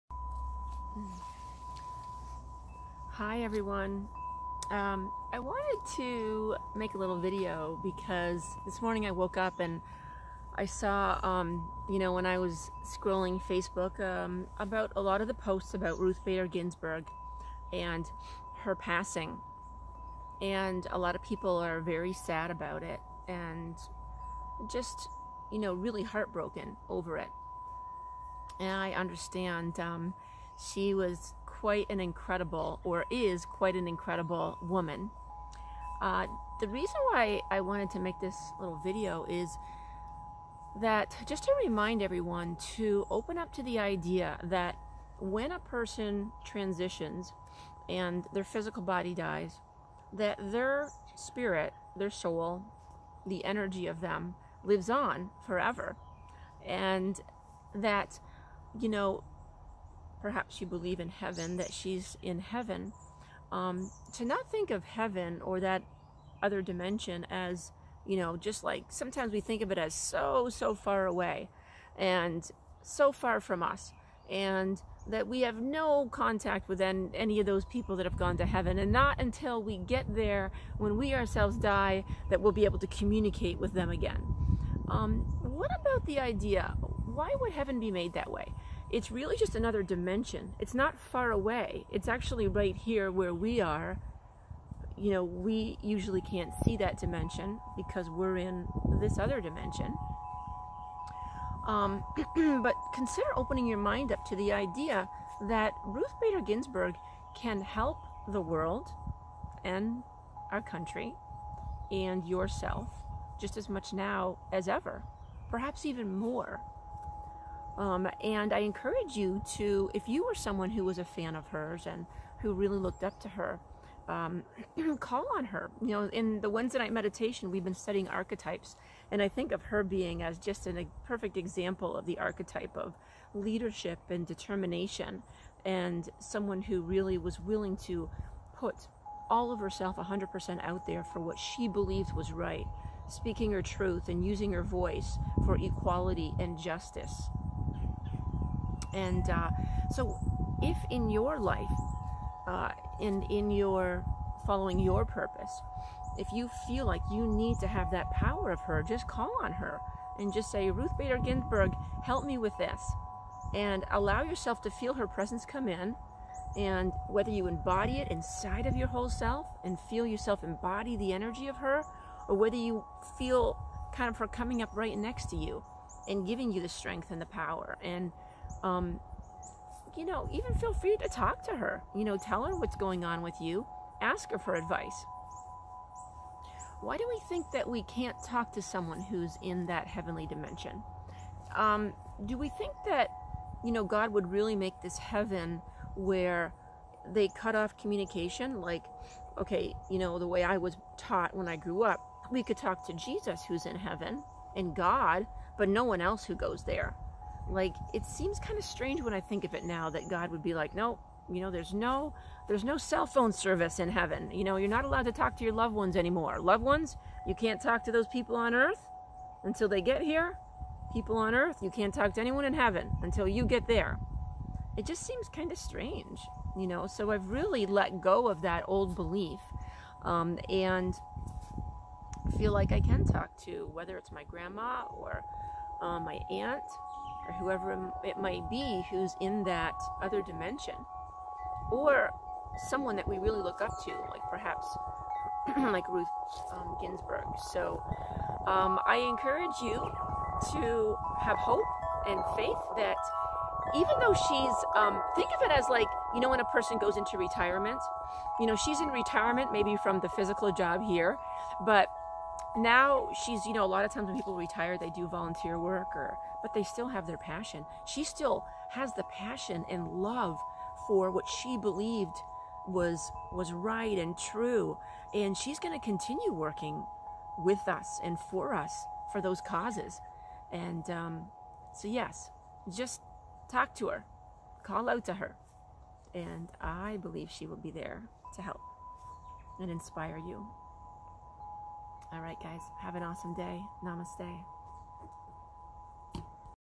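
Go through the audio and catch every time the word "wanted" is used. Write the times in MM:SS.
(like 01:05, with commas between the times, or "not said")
00:05, 00:37.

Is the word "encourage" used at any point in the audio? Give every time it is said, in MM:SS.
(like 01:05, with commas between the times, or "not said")
01:58, 04:08.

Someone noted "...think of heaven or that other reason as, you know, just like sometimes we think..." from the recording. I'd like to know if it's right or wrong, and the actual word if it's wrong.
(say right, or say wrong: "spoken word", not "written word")
wrong: "dimension", not "reason".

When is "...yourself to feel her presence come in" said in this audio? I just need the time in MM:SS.
02:44.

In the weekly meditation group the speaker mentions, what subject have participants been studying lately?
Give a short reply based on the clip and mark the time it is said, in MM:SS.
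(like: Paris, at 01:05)
archetypes, at 02:08.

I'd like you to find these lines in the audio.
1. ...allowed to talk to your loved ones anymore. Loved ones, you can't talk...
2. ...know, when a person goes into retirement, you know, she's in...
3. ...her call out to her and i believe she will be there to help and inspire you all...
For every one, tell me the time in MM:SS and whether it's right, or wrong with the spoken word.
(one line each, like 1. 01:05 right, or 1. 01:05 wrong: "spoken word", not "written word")
1. 03:34 right
2. 04:16 right
3. 04:43 right.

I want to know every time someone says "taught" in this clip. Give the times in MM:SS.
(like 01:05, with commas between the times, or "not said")
03:20.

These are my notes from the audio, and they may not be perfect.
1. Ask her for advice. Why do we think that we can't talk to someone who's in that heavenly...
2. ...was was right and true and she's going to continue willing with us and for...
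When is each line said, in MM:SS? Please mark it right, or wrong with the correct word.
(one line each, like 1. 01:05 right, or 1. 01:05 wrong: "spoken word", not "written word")
1. 03:04 right
2. 04:32 wrong: "working", not "willing".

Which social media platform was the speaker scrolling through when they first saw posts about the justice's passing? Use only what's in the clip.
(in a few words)
Facebook.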